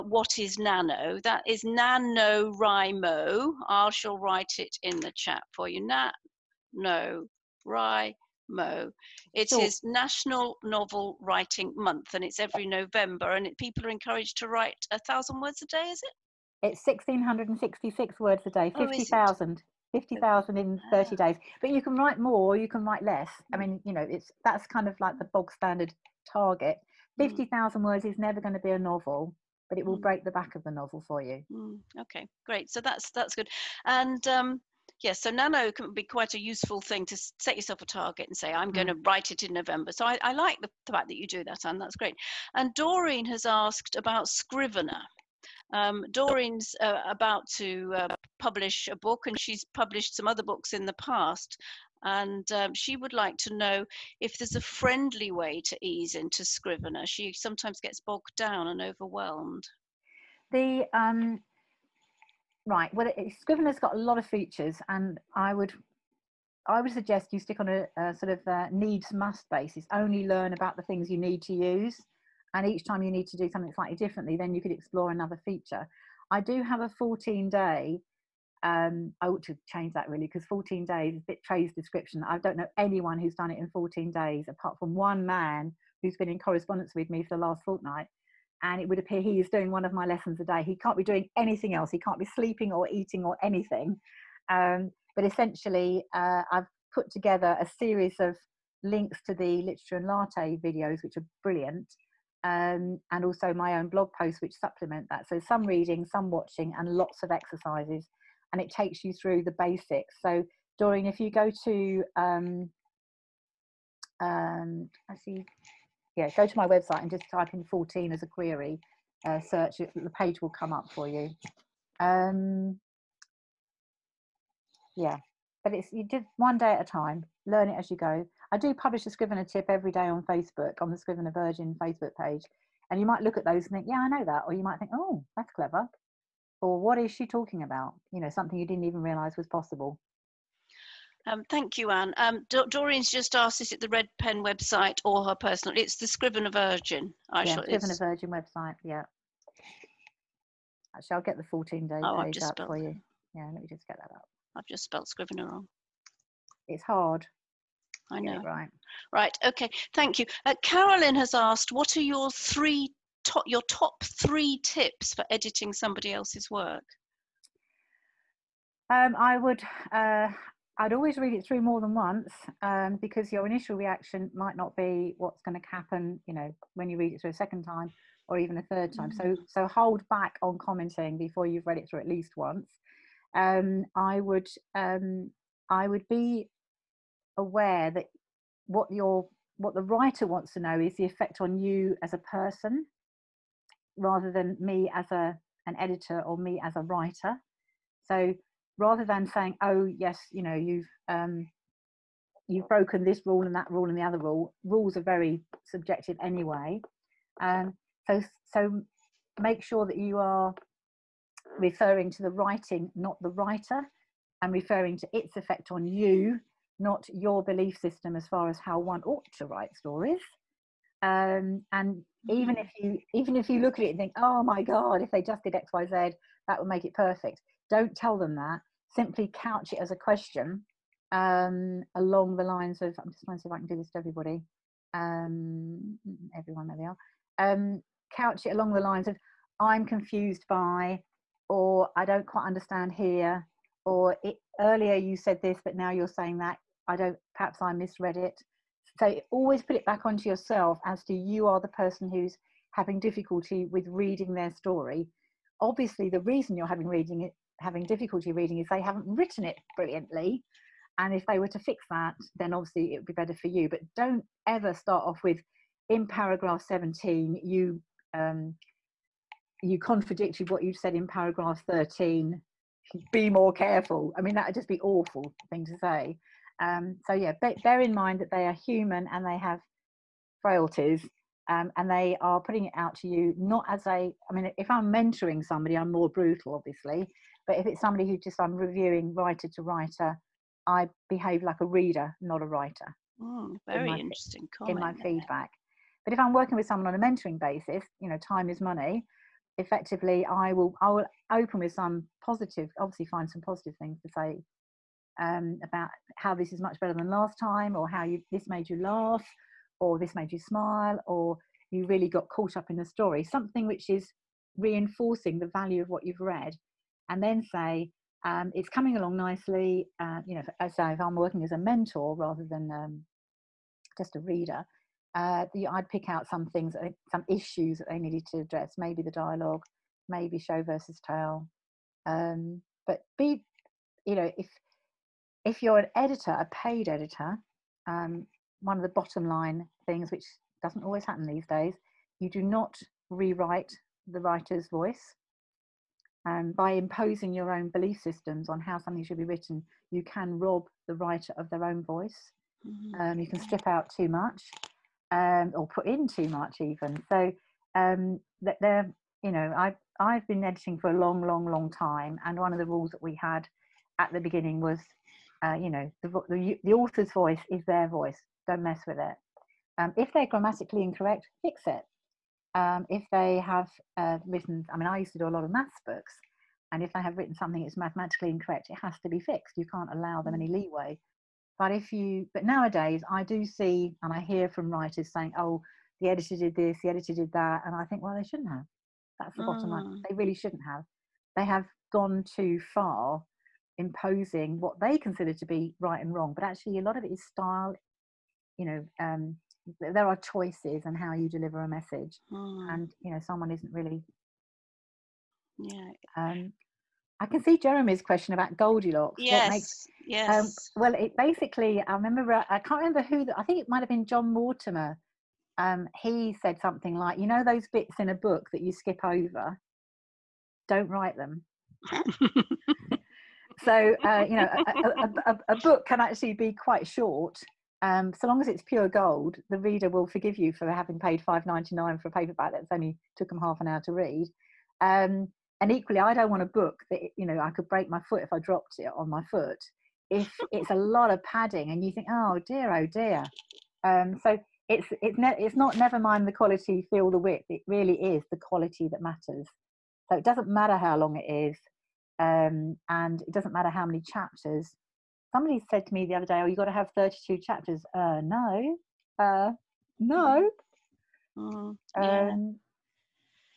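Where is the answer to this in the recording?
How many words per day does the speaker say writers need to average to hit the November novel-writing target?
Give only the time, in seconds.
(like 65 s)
16 s.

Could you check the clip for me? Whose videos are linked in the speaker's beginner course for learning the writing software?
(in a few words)
Literature and Latte.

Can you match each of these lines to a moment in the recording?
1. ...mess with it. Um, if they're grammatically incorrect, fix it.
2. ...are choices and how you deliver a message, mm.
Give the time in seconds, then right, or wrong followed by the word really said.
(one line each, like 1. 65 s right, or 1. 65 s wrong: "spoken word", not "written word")
1. 368 s right
2. 400 s right.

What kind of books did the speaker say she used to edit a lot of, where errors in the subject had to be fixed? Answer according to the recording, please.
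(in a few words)
maths books.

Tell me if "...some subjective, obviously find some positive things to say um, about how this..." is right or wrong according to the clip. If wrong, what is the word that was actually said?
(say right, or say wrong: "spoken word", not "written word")
wrong: "positive", not "subjective".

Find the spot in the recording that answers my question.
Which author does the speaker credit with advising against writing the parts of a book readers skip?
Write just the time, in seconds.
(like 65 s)
414 s.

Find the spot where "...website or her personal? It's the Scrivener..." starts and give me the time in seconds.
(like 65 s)
144 s.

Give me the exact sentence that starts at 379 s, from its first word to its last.
You can't allow them any mm.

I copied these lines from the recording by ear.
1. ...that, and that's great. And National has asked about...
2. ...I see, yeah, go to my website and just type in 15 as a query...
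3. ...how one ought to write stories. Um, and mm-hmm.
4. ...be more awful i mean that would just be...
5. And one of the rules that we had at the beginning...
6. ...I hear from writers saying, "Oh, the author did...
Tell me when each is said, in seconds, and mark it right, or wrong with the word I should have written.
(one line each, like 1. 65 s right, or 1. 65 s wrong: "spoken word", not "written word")
1. 41 s wrong: "Doreen", not "National"
2. 115 s wrong: "14", not "15"
3. 218 s right
4. 273 s wrong: "careful", not "awful"
5. 362 s right
6. 384 s wrong: "editor", not "author".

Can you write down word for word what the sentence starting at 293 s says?
Mm, very in my, interesting comment in my there.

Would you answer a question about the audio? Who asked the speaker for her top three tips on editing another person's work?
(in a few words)
Carolyn.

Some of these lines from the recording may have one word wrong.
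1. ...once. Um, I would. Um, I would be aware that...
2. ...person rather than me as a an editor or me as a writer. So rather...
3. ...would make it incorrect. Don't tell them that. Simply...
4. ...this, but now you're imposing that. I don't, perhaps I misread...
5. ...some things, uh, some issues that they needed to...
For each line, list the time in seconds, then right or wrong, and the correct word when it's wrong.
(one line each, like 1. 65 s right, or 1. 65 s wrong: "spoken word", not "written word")
1. 182 s right
2. 192 s right
3. 226 s wrong: "perfect", not "incorrect"
4. 245 s wrong: "saying", not "imposing"
5. 326 s right.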